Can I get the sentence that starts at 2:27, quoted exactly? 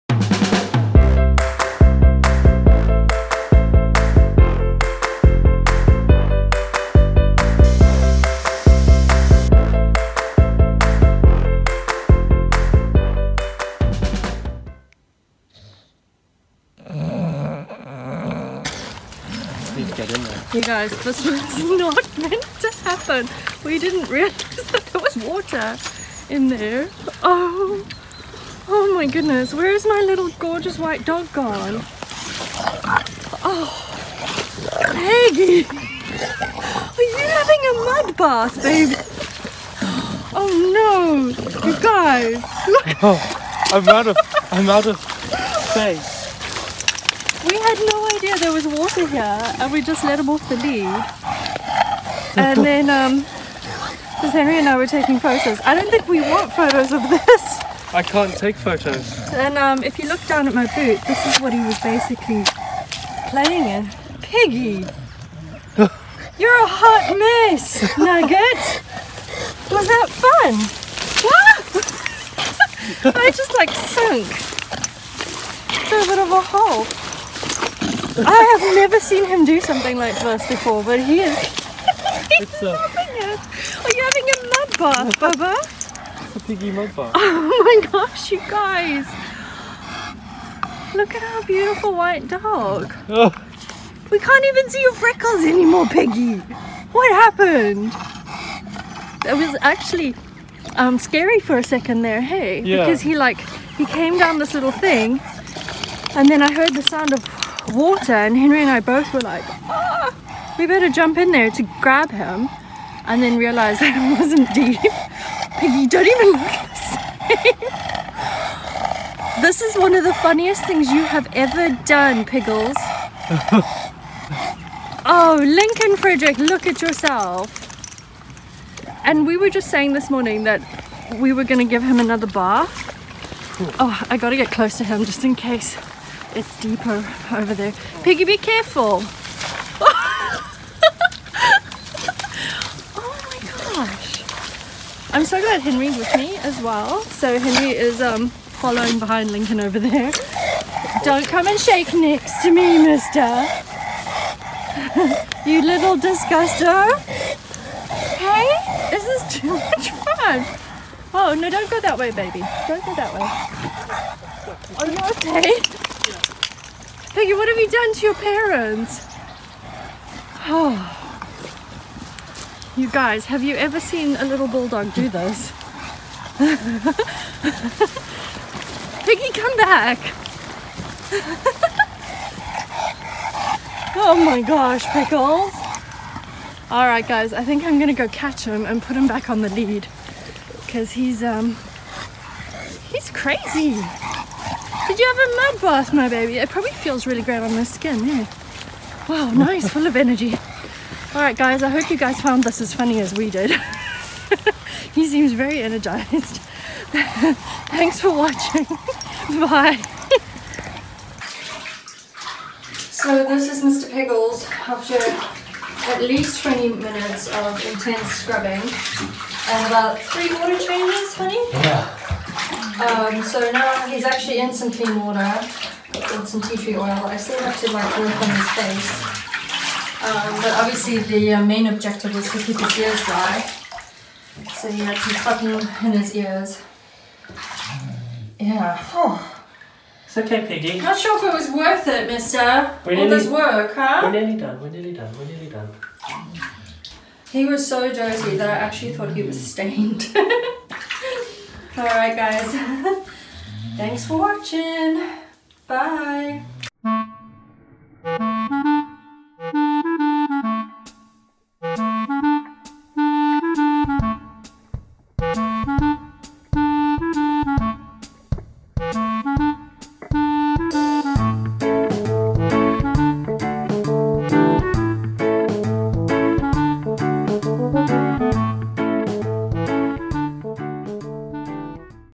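So Henry is um, following behind Lincoln over there.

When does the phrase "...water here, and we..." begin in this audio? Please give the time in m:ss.
0:48.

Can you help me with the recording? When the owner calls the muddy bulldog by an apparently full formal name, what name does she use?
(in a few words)
Lincoln Frederick.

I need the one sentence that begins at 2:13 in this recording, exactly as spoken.
Oh, I got to get close to him just in case.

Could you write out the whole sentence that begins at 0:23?
We didn't realize that there was water in there.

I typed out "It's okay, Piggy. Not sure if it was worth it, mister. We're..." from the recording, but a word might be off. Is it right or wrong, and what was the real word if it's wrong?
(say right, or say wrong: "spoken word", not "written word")
right.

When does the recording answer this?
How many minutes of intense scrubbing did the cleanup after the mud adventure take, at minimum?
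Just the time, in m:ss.
3:36.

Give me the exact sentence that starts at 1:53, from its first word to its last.
And then realized that it wasn't deep.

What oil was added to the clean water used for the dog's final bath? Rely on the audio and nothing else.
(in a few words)
tea tree oil.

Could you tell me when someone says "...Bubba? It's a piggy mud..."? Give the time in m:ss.
1:25.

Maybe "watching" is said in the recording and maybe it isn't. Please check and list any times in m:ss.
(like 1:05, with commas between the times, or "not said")
3:28, 4:14.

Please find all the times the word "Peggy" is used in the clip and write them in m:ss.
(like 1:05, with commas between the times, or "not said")
0:34, 1:35, 2:47.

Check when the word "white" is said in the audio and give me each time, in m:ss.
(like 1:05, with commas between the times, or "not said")
0:30, 1:31.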